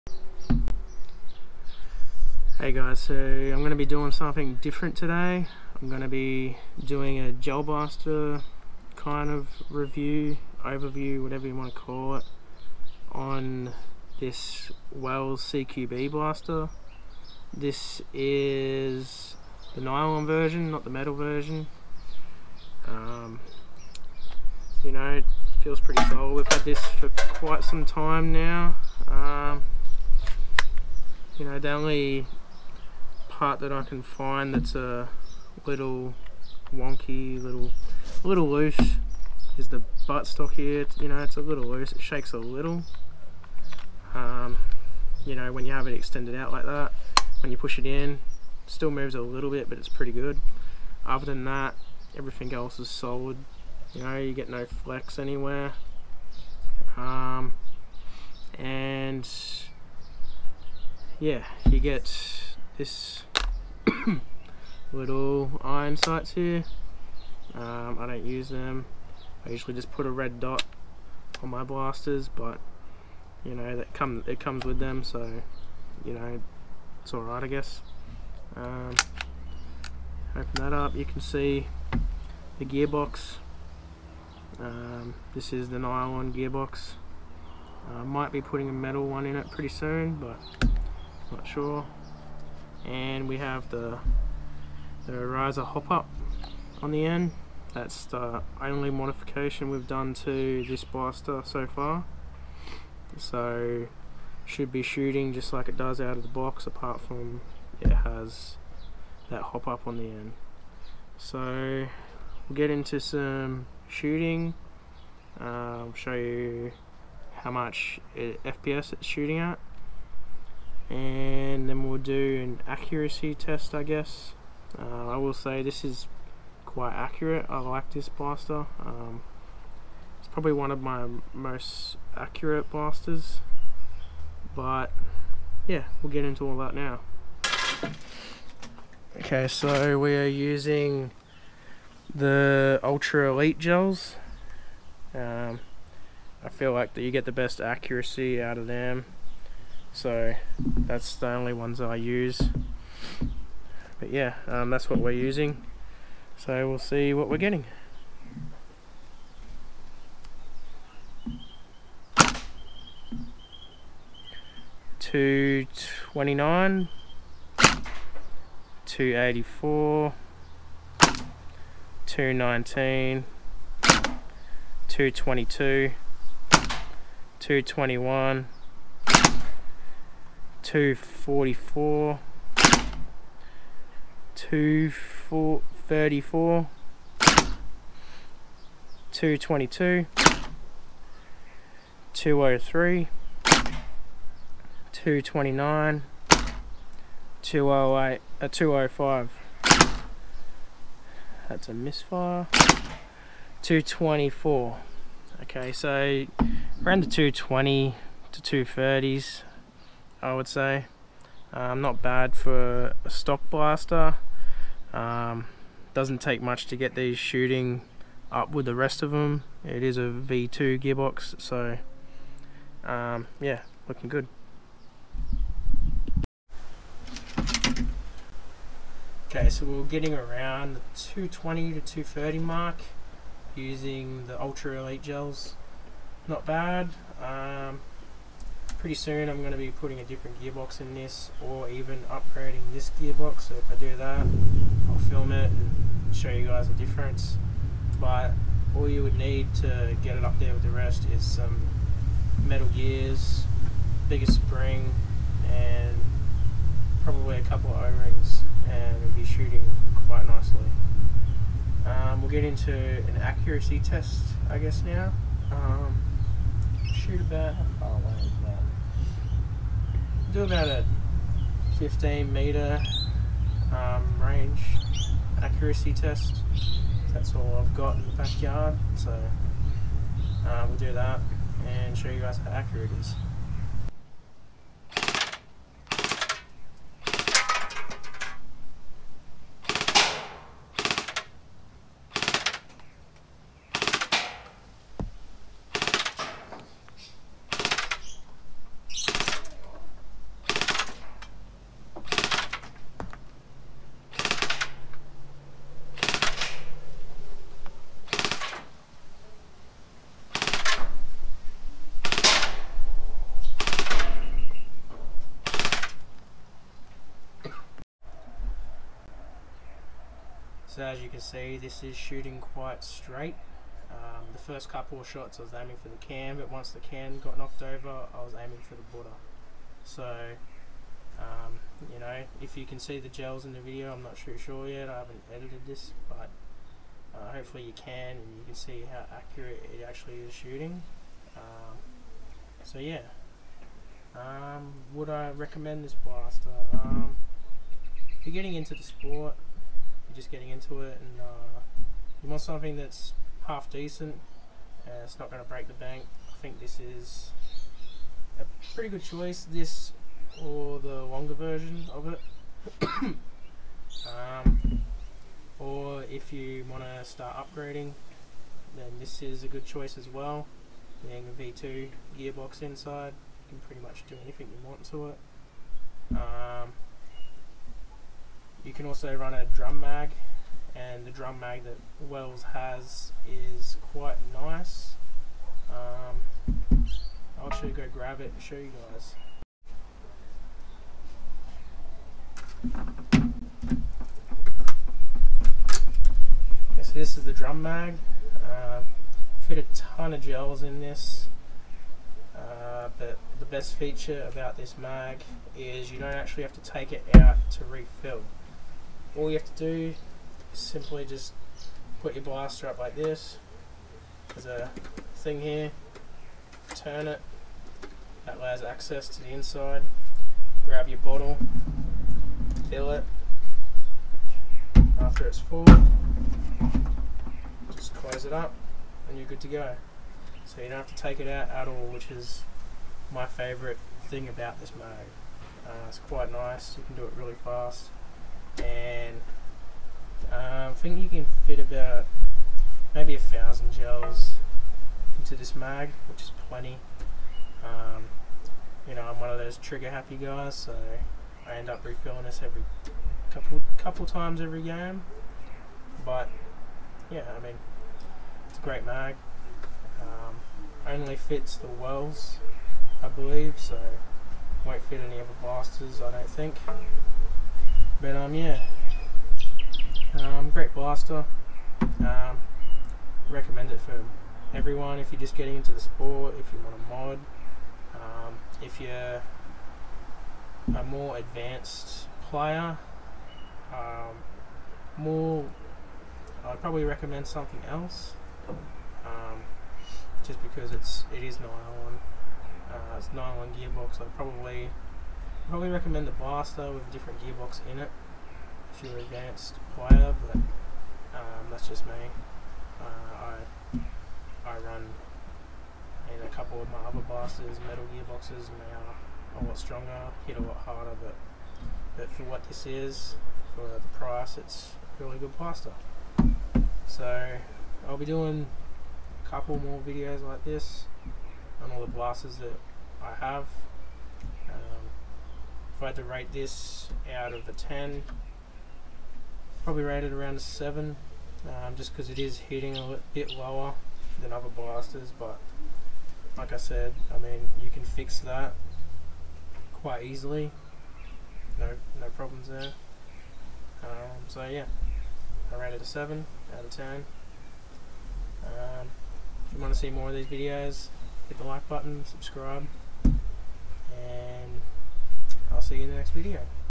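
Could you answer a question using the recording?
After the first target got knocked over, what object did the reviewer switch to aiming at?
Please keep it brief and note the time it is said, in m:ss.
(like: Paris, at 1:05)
The Buddha, at 5:28.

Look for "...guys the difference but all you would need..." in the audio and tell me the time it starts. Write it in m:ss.
4:06.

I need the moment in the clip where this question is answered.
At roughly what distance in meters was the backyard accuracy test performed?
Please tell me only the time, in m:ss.
4:31.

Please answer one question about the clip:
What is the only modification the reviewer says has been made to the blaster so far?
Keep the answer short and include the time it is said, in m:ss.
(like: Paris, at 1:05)
Riser hop up, at 1:35.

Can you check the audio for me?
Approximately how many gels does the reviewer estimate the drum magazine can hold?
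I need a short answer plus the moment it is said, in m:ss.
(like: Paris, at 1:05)
1000, at 7:23.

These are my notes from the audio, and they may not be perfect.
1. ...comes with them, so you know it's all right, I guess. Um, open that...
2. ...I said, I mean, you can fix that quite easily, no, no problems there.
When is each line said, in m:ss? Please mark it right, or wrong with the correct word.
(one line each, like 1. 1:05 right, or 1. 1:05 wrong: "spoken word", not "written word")
1. 1:14 right
2. 8:56 right.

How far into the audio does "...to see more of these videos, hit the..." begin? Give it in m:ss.
9:09.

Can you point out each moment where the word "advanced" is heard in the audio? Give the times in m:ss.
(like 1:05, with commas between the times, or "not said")
8:01, 8:19.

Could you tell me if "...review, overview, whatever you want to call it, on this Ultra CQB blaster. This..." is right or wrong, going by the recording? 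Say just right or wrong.
wrong.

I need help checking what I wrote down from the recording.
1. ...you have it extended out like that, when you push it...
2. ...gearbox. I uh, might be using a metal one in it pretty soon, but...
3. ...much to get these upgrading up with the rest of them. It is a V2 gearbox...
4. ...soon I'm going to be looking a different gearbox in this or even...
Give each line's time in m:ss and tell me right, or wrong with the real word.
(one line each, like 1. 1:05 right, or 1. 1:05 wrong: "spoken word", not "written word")
1. 0:45 right
2. 1:26 wrong: "putting", not "using"
3. 3:36 wrong: "shooting", not "upgrading"
4. 3:58 wrong: "putting", not "looking".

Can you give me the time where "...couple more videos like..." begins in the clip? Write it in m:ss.
8:39.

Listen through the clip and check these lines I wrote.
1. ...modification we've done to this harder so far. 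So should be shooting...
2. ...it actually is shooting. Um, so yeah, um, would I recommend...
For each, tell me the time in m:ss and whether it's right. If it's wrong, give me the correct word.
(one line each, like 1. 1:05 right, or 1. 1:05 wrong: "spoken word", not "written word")
1. 1:38 wrong: "blaster", not "harder"
2. 5:39 right.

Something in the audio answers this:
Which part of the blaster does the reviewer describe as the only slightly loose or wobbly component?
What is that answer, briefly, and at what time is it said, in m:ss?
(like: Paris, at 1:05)
Buttstock, at 0:40.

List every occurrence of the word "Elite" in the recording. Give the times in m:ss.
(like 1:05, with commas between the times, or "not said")
2:23, 3:54.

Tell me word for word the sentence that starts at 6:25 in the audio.
Um, I'll actually go grab it and show you guys.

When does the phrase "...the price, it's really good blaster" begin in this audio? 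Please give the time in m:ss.
8:33.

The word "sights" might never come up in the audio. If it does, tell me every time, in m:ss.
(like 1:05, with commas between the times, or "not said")
1:05.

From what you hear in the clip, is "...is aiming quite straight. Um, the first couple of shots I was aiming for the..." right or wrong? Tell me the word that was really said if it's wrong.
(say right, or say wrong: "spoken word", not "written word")
wrong: "shooting", not "aiming".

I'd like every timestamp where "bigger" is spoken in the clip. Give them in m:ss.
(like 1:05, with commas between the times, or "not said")
4:14.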